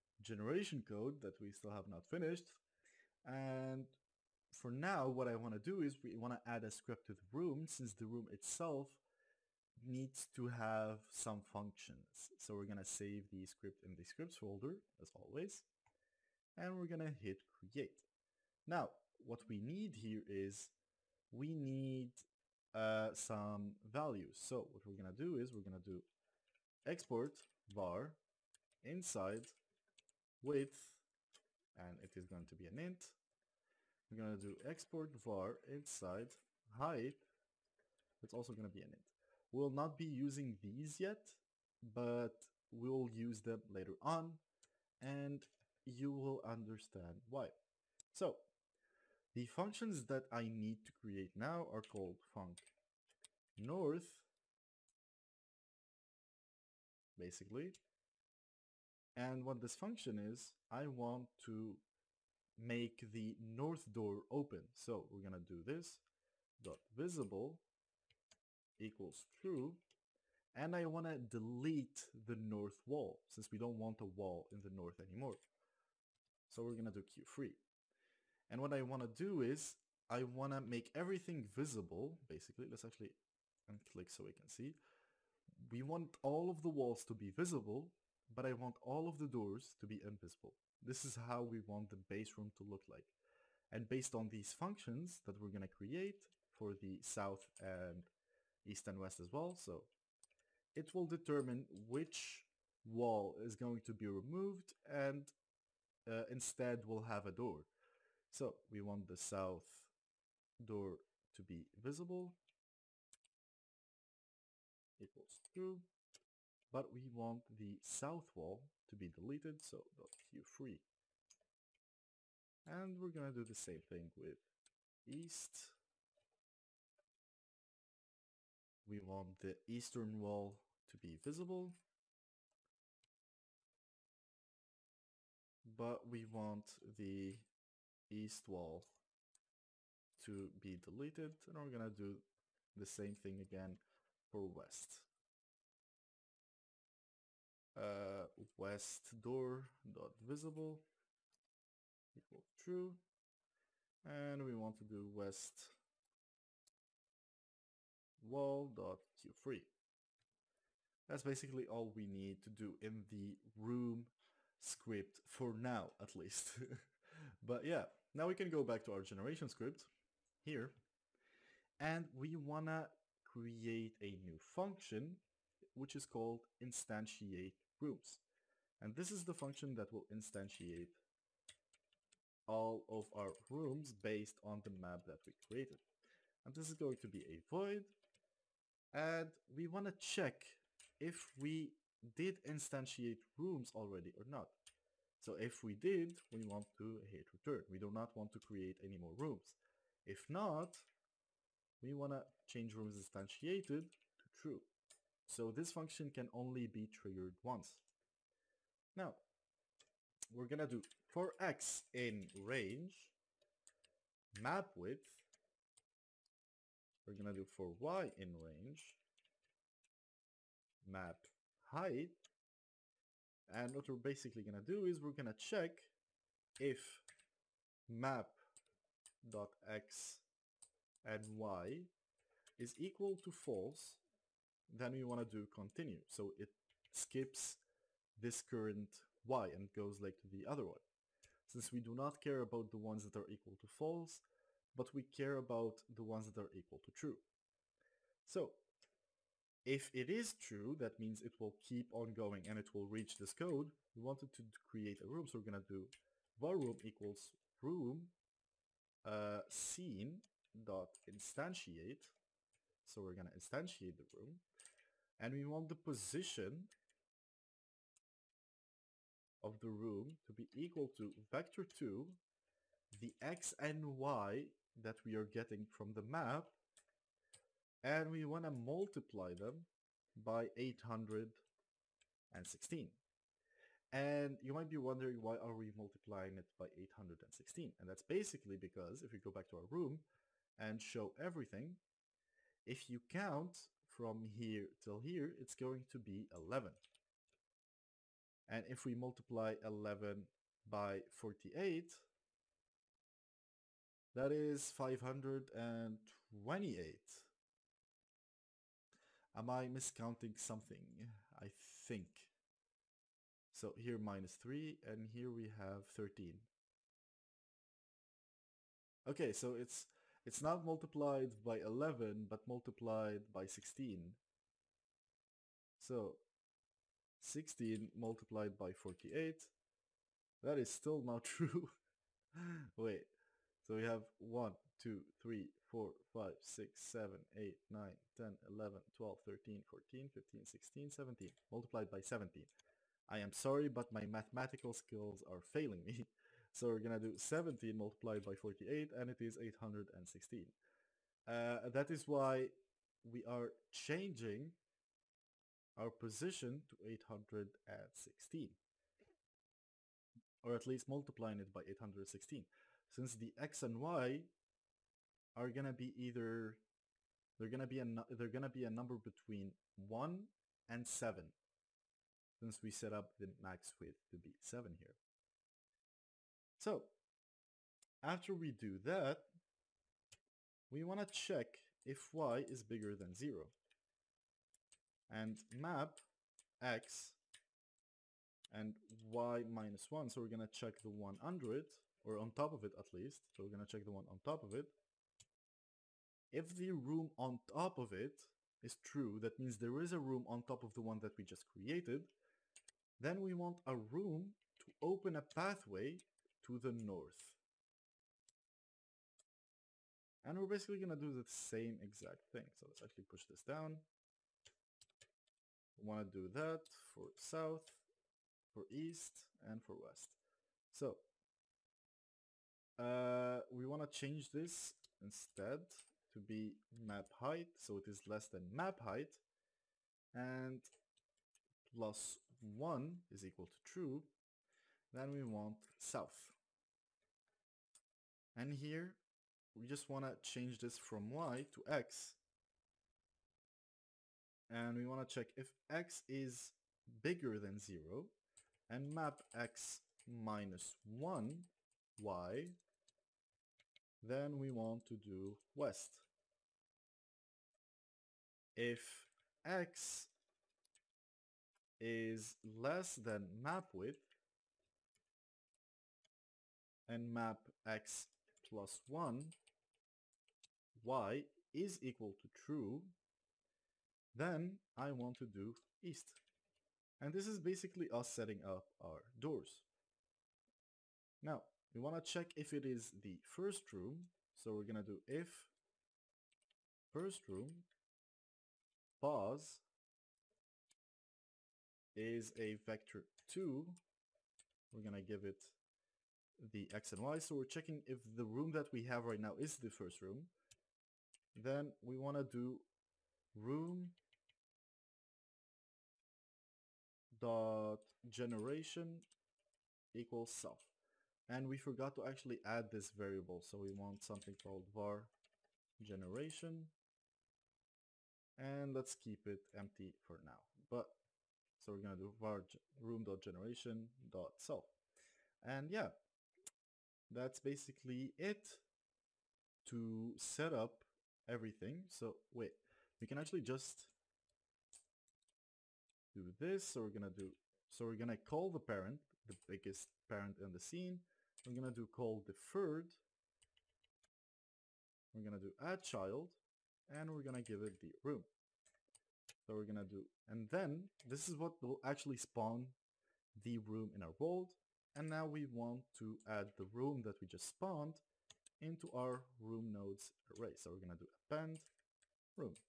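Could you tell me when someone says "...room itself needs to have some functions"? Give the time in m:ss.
0:08.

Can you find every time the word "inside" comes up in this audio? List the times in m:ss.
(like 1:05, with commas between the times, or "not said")
0:28, 0:35.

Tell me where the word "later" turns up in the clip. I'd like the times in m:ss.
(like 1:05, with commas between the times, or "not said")
0:43.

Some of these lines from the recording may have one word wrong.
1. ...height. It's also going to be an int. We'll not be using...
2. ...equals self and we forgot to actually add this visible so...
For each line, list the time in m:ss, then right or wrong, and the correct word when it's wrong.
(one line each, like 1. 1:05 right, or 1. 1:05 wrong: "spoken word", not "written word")
1. 0:36 right
2. 8:29 wrong: "variable", not "visible".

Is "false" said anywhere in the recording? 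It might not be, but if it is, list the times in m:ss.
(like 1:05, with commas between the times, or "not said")
3:53, 4:03.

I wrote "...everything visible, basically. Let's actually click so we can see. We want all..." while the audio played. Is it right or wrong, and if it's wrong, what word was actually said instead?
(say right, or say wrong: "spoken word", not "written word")
right.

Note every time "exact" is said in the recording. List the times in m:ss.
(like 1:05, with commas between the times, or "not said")
6:51.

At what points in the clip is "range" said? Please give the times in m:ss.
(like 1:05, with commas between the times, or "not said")
3:32, 3:38.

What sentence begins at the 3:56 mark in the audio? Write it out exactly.
So it skips this current y and goes like to the other one.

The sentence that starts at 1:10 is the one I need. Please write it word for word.
And I want to delete the north wall since we don't want a wall in the north anymore.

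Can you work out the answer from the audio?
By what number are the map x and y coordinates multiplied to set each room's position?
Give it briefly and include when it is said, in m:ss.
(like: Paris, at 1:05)
816, at 4:38.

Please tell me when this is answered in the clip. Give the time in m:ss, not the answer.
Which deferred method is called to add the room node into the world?
9:05.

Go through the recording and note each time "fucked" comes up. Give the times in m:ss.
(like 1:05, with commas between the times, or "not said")
not said.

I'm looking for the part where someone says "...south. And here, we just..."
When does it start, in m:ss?
7:15.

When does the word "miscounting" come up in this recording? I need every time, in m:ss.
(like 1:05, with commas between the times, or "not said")
5:09.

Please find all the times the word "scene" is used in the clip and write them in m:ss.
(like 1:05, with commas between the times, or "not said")
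4:19, 9:00.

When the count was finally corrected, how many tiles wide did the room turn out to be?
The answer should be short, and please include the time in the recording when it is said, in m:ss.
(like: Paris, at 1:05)
17, at 5:41.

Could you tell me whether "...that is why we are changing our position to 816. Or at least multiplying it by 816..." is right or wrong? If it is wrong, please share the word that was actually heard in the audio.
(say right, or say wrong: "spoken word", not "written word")
right.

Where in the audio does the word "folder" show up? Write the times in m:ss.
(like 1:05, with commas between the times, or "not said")
0:14.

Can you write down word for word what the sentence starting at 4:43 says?
And you might be wondering why are we multiplying it by 816?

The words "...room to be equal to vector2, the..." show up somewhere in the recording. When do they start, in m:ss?
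4:29.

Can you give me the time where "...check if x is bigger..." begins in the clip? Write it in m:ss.
7:25.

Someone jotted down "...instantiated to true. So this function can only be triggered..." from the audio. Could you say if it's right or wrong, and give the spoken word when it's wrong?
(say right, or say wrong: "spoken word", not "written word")
right.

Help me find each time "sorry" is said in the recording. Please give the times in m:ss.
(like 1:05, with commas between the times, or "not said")
5:43.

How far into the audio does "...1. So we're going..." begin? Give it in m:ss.
6:29.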